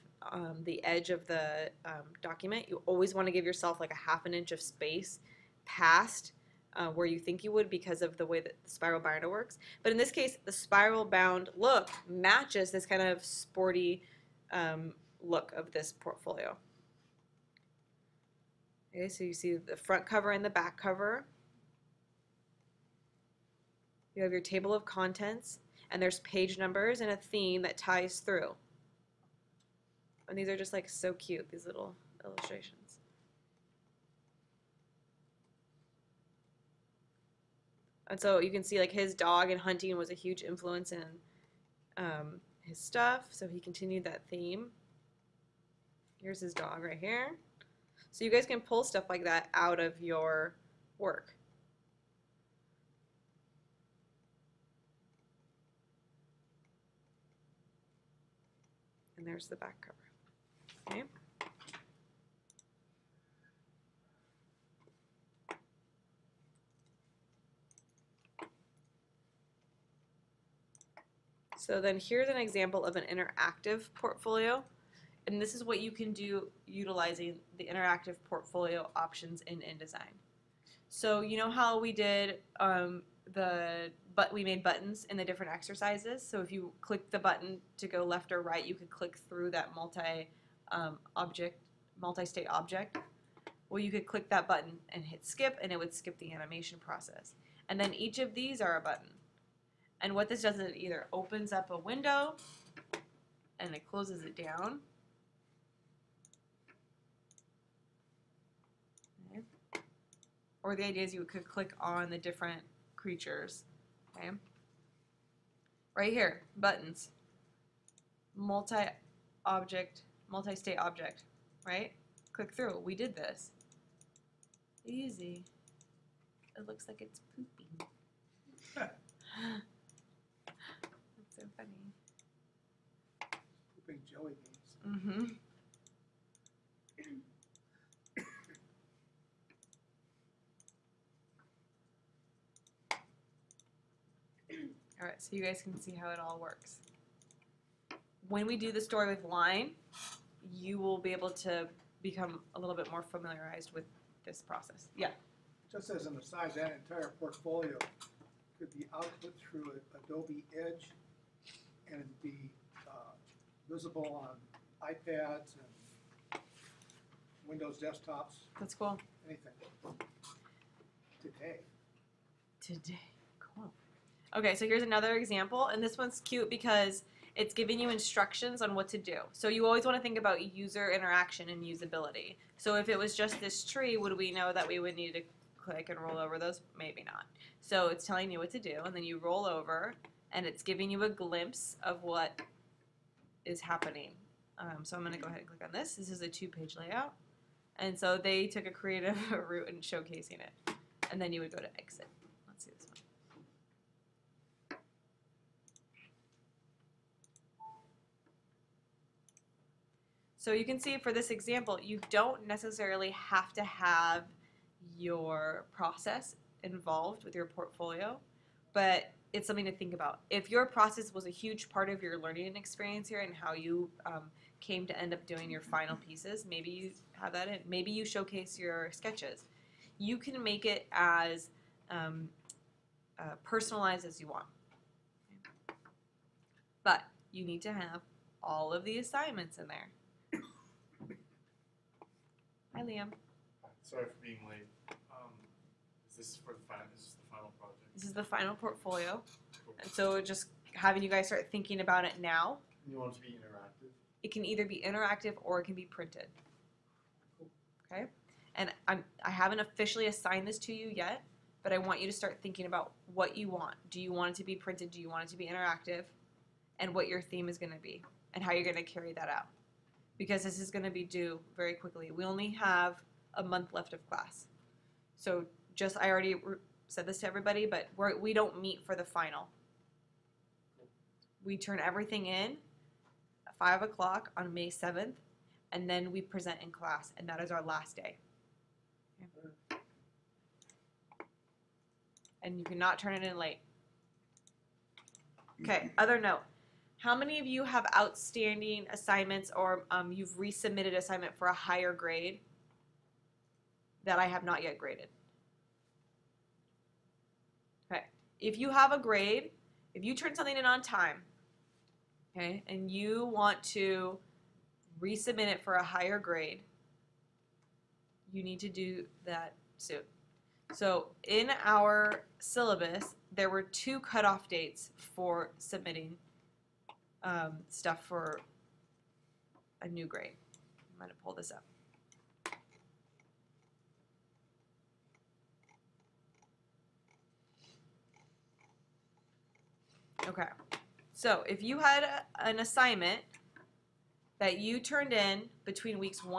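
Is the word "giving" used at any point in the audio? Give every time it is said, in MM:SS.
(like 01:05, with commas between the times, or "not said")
02:57, 03:10.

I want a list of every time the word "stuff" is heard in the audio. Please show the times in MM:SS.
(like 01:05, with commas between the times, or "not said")
00:42, 00:48, 05:27.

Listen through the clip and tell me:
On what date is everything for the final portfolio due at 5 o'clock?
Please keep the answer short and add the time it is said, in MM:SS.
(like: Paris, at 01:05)
May 7th, at 04:44.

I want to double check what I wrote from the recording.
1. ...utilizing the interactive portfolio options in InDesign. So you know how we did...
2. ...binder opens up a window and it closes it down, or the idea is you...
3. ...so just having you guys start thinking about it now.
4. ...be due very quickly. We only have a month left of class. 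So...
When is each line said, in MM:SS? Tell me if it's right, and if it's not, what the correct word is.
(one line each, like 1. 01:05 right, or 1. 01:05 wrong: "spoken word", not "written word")
1. 01:16 right
2. 01:40 wrong: "either", not "binder"
3. 04:09 right
4. 04:30 right.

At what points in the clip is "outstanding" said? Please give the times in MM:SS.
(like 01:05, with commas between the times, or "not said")
04:57.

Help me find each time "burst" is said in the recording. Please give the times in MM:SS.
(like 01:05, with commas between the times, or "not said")
not said.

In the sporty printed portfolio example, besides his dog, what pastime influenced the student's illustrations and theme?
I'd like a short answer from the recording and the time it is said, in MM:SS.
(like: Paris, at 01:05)
hunting, at 00:39.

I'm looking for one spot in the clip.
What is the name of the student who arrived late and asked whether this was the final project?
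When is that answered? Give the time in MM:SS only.
04:02.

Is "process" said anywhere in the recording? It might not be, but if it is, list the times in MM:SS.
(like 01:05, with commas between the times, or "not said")
01:36, 02:34, 03:35, 03:40.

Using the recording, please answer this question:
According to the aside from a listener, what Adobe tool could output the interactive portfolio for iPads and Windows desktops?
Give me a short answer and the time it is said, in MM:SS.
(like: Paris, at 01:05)
Adobe Edge, at 02:40.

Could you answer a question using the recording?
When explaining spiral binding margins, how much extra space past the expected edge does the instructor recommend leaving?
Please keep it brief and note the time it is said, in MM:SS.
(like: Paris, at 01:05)
half an inch, at 00:03.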